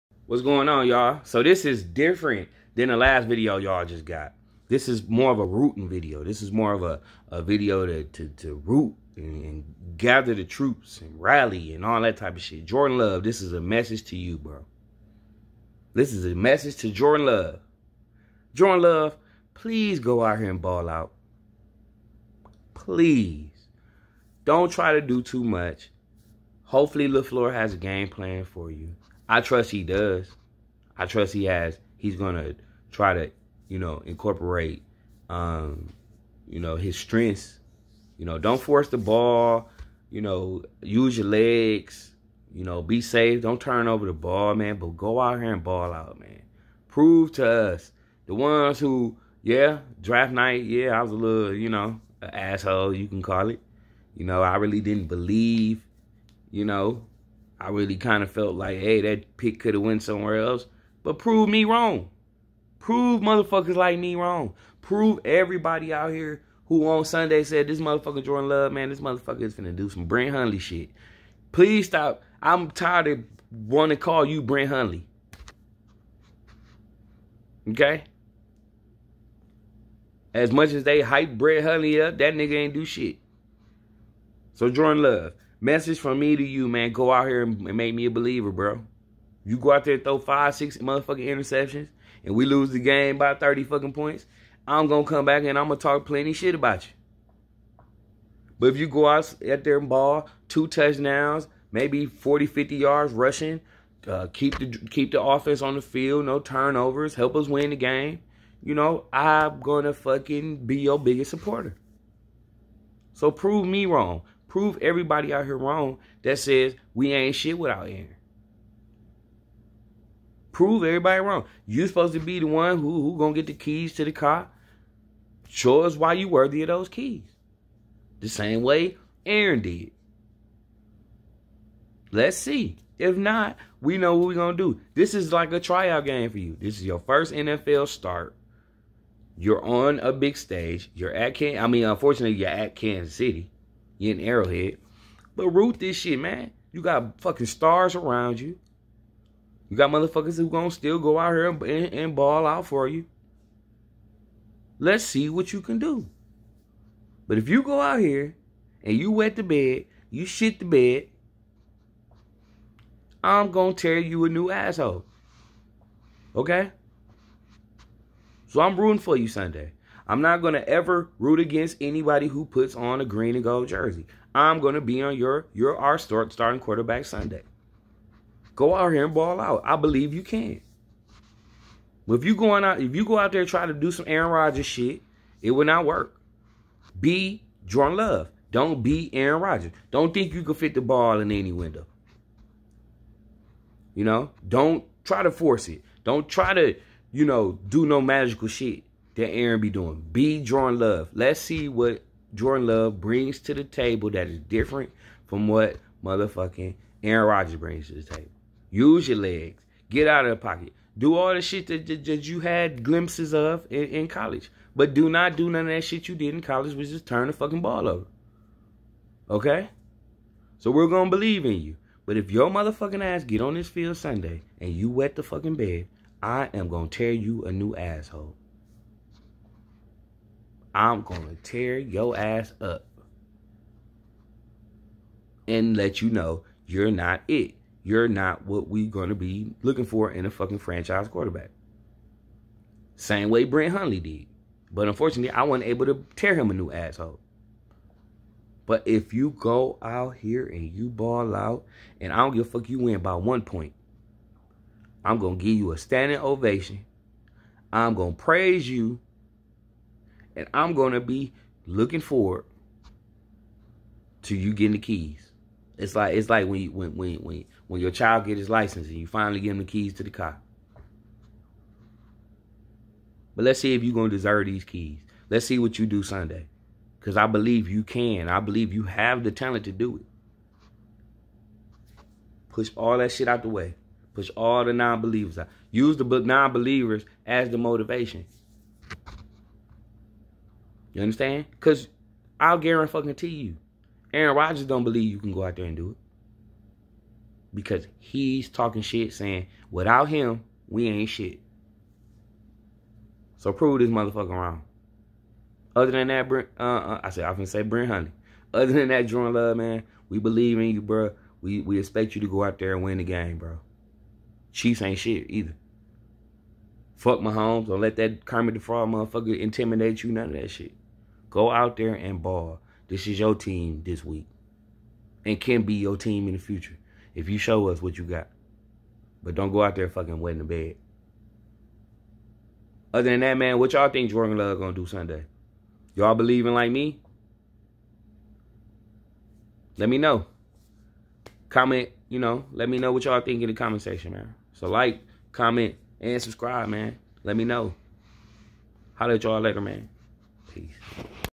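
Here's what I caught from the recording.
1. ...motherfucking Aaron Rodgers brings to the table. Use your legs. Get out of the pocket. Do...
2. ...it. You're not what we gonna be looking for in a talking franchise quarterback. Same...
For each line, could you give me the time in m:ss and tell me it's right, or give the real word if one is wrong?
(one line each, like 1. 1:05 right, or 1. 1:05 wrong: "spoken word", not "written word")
1. 3:26 right
2. 3:57 wrong: "fucking", not "talking".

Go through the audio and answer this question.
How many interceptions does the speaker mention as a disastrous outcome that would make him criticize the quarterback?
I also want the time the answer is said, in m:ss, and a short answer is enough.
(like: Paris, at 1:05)
5 or 6, at 1:30.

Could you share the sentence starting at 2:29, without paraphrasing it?
You got motherfuckers who gonna still go out here and, and, and ball out for you.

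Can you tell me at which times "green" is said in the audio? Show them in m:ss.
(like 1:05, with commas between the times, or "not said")
2:53.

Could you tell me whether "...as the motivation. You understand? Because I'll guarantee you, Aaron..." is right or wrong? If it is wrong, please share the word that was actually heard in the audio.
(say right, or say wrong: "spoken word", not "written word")
right.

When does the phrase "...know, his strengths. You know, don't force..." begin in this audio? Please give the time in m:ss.
0:36.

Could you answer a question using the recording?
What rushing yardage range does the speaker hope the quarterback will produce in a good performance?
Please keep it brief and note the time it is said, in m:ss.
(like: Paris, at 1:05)
40-50 yards, at 1:42.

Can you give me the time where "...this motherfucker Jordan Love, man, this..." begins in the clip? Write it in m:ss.
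1:07.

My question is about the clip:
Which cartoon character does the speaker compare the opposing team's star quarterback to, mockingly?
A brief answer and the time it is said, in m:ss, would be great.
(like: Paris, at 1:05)
Kermit the Frog, at 5:18.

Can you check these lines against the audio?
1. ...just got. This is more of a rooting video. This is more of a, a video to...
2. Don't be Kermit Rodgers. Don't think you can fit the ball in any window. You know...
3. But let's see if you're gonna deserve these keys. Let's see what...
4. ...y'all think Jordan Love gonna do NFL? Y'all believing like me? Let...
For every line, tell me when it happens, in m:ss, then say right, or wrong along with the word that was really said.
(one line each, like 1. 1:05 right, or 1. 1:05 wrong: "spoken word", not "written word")
1. 0:03 right
2. 3:08 wrong: "Aaron", not "Kermit"
3. 4:33 right
4. 5:33 wrong: "Sunday", not "NFL".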